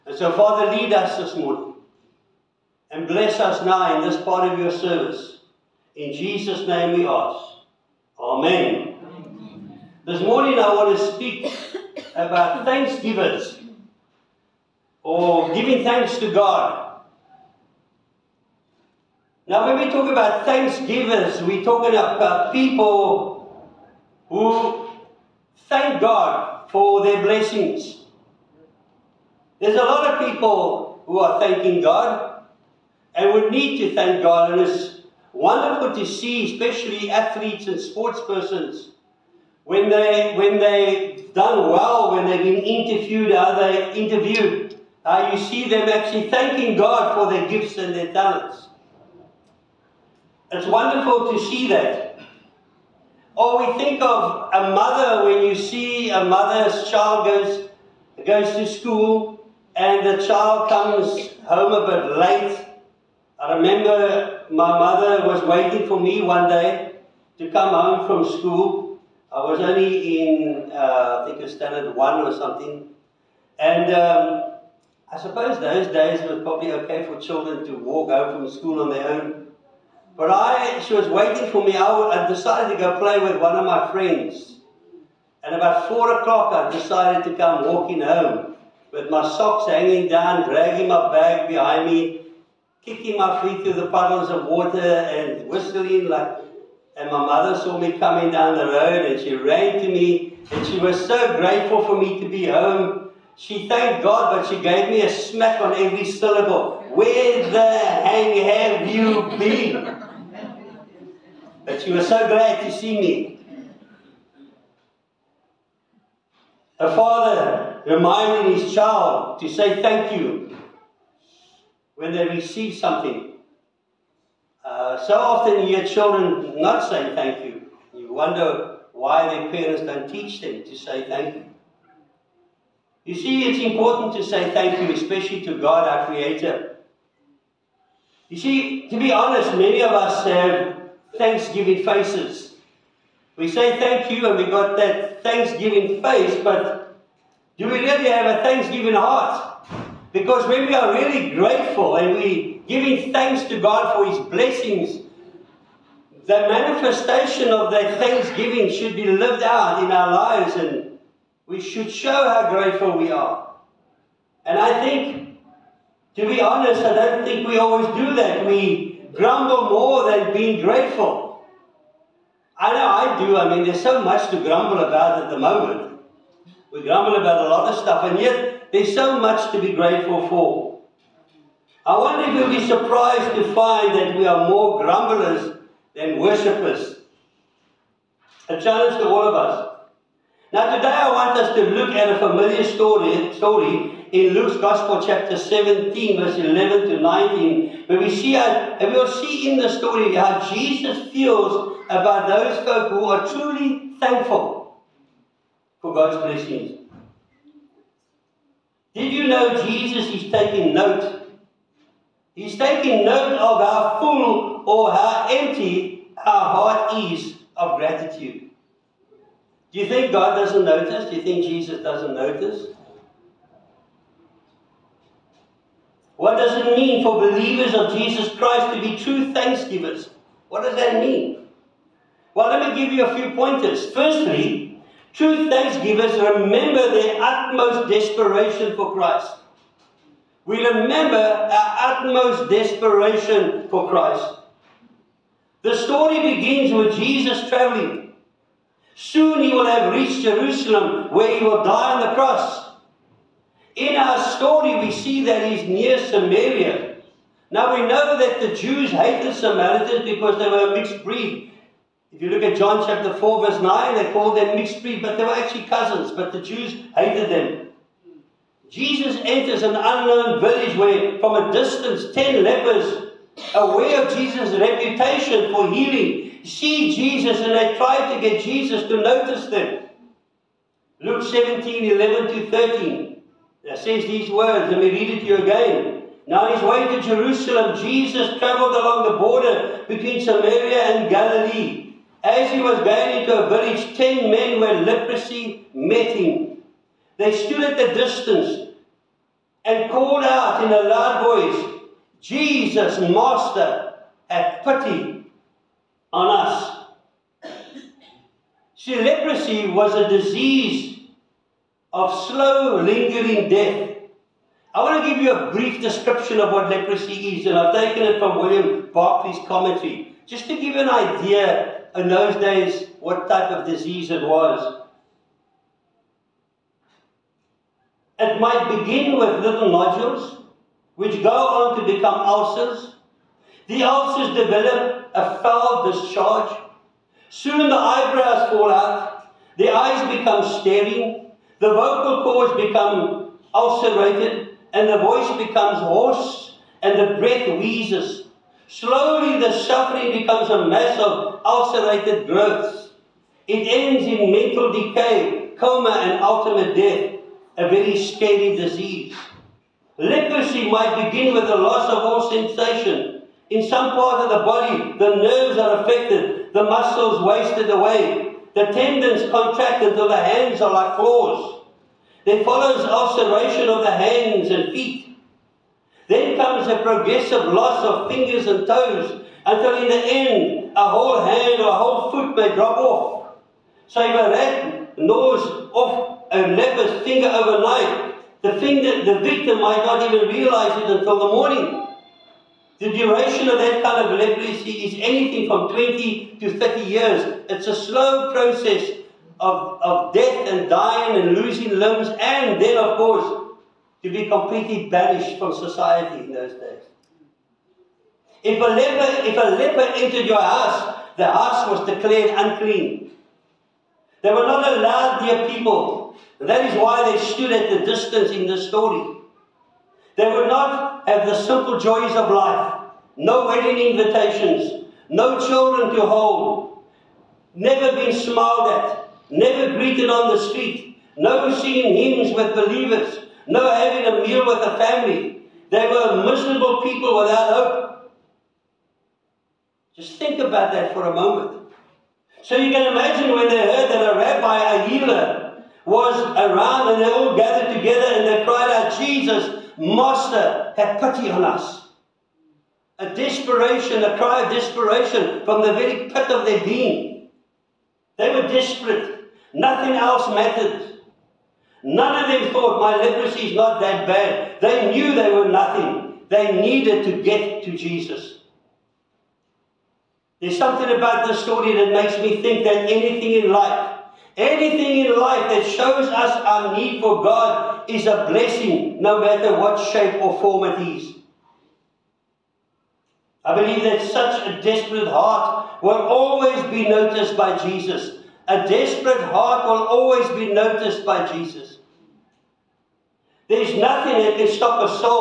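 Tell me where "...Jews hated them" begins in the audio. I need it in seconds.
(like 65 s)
266 s.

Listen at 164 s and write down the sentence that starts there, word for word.
And I think, to be honest, I don't think we always do that.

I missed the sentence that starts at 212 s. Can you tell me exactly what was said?
He's taking note of how full or how empty our heart is of gratitude.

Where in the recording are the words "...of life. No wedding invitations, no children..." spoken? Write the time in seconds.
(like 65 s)
422 s.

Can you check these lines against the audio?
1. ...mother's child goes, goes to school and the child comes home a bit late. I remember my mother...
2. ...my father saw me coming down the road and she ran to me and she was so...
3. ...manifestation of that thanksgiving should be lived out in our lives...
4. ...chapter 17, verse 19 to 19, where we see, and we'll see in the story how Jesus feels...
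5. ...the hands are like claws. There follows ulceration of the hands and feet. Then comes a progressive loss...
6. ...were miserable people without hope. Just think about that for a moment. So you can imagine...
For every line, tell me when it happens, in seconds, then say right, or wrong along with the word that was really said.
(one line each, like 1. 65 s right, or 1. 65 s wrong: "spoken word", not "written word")
1. 56 s right
2. 97 s wrong: "mother", not "father"
3. 156 s right
4. 195 s wrong: "11", not "19"
5. 370 s right
6. 435 s right.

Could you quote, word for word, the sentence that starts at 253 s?
In our story, we see that he's near Samaria.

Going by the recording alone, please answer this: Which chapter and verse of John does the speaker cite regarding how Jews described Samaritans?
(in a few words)
John 4:9.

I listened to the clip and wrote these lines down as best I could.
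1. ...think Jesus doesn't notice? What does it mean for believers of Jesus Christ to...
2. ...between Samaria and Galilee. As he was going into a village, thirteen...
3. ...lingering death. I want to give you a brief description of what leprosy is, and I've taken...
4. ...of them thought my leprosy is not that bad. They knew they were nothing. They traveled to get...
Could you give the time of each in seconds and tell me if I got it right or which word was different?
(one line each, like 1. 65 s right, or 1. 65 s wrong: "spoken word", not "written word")
1. 221 s right
2. 289 s wrong: "ten", not "thirteen"
3. 312 s right
4. 462 s wrong: "needed", not "traveled".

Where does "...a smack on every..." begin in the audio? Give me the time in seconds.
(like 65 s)
105 s.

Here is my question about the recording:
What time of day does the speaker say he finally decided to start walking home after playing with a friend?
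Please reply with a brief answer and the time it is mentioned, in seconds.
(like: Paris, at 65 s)
four o'clock, at 85 s.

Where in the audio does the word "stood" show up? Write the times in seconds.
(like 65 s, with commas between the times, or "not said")
297 s, 417 s.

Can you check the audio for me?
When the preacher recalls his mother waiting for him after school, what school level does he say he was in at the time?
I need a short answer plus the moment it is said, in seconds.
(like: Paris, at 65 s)
standard one, at 71 s.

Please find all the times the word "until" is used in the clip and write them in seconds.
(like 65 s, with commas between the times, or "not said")
369 s, 379 s, 390 s.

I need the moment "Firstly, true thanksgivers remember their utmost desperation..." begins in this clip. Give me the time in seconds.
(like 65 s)
233 s.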